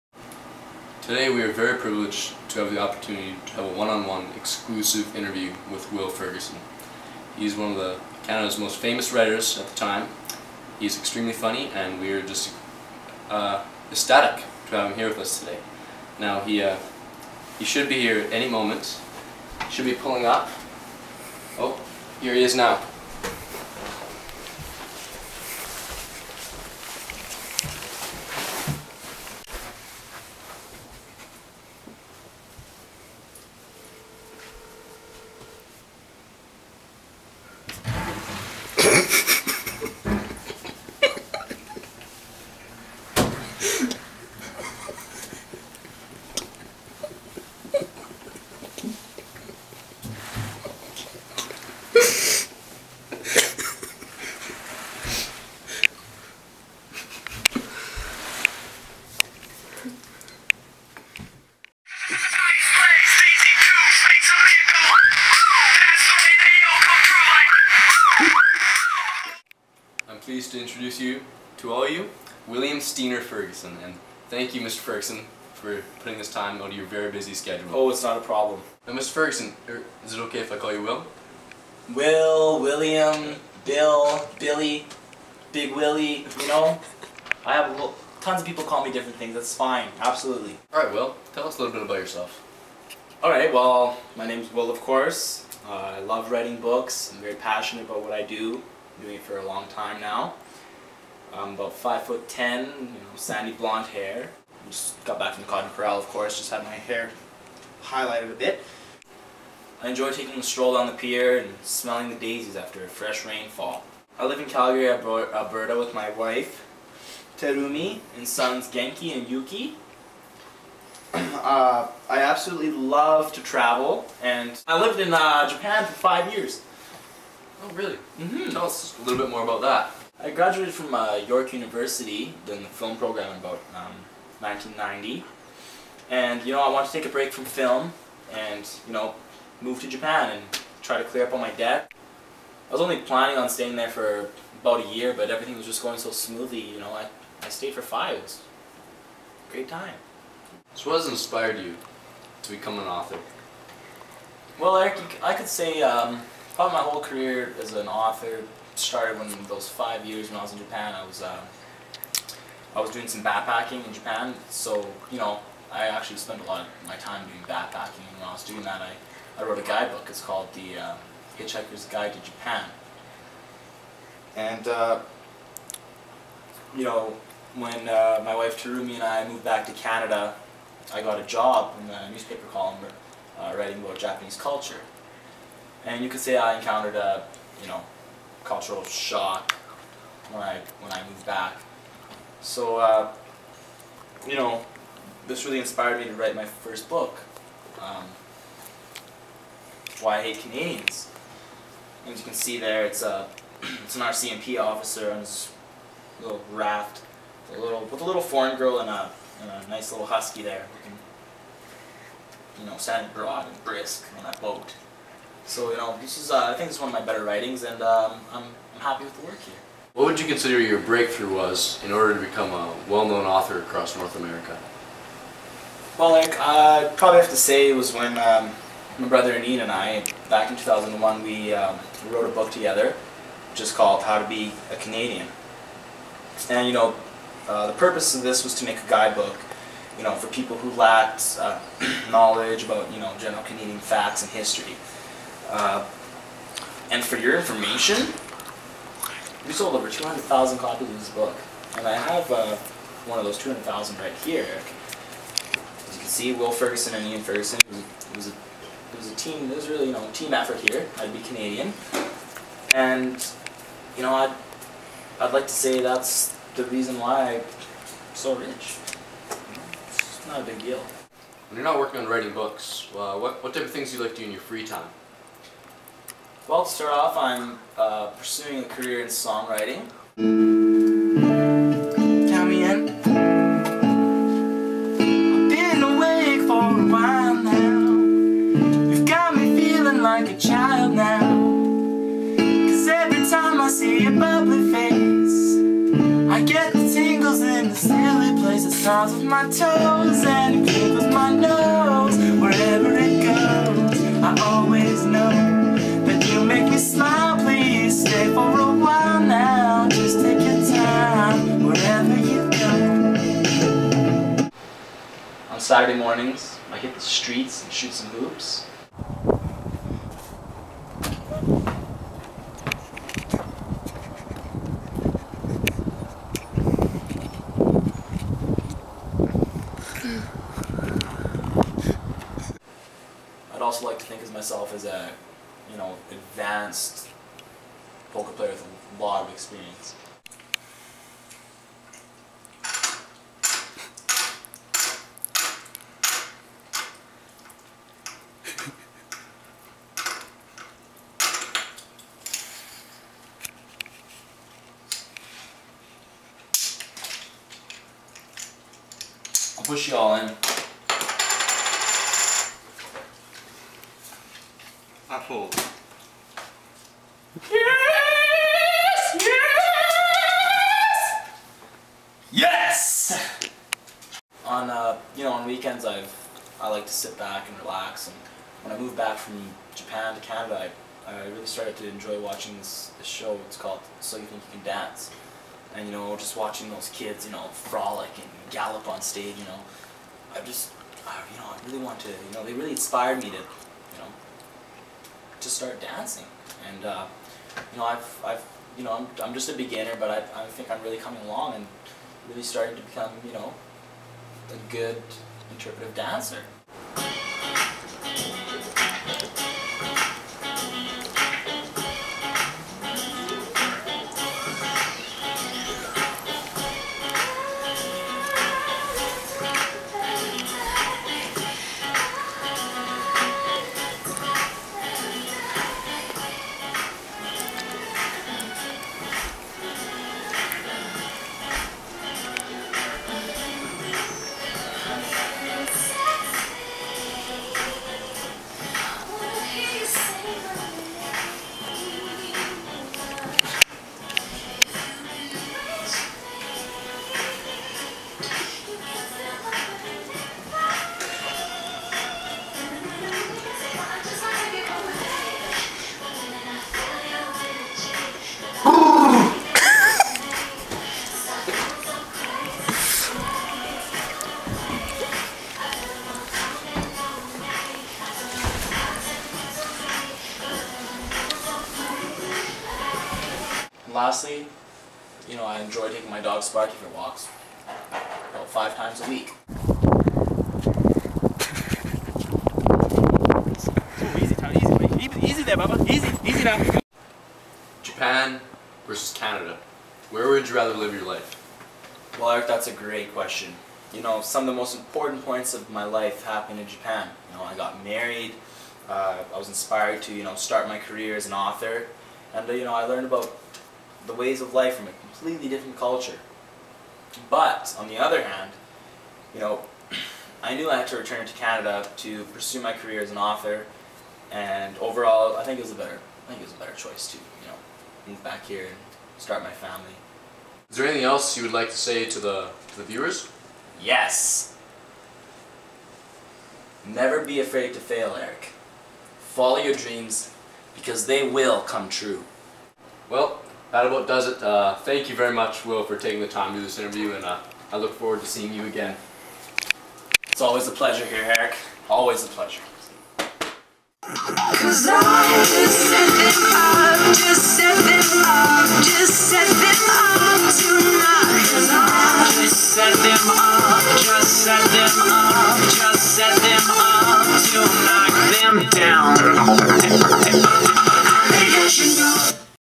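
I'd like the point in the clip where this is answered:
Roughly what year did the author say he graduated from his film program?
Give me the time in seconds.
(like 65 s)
134 s.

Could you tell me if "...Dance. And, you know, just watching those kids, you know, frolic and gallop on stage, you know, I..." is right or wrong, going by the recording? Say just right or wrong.
right.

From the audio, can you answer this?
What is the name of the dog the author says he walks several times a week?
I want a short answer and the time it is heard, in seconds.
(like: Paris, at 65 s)
Sparky, at 476 s.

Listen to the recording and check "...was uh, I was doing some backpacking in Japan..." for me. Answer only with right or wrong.
right.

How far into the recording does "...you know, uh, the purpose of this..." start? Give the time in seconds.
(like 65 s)
236 s.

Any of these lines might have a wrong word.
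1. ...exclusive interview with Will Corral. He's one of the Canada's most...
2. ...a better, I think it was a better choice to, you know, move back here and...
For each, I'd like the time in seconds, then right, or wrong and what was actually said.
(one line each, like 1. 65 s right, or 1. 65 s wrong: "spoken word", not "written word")
1. 4 s wrong: "Ferguson", not "Corral"
2. 515 s right.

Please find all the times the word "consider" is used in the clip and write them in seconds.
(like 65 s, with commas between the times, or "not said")
220 s.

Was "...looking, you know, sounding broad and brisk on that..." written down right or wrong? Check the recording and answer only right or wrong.
right.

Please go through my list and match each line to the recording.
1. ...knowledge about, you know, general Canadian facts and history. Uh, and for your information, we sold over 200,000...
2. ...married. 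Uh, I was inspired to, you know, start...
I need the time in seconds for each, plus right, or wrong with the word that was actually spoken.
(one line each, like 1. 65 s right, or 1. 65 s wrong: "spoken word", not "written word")
1. 242 s right
2. 497 s right.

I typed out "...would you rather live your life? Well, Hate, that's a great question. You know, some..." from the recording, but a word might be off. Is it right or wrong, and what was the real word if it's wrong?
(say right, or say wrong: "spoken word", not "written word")
wrong: "Eric", not "Hate".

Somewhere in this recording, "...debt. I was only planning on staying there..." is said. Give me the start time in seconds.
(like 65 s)
141 s.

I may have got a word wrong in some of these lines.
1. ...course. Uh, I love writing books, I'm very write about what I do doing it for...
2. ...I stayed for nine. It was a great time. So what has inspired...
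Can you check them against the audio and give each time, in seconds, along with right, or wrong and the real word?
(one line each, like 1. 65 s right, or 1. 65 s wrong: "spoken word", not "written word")
1. 94 s wrong: "passionate", not "write"
2. 147 s wrong: "five", not "nine".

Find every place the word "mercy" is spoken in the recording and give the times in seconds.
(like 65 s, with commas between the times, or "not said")
not said.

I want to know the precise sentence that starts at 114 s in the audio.
I live in Calgary, Alberta with my wife, Terumi, and sons Genki and Yuki.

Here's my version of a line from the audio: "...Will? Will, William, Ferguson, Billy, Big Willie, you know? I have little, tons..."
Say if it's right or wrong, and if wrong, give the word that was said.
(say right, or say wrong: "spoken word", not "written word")
wrong: "Bill", not "Ferguson".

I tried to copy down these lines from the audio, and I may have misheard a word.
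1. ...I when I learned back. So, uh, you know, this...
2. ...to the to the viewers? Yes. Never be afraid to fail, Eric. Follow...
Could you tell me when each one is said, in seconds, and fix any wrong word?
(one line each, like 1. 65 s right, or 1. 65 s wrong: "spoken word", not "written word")
1. 190 s wrong: "moved", not "learned"
2. 522 s right.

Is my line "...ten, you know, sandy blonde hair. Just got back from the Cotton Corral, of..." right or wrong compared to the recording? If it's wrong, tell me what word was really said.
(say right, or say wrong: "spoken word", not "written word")
right.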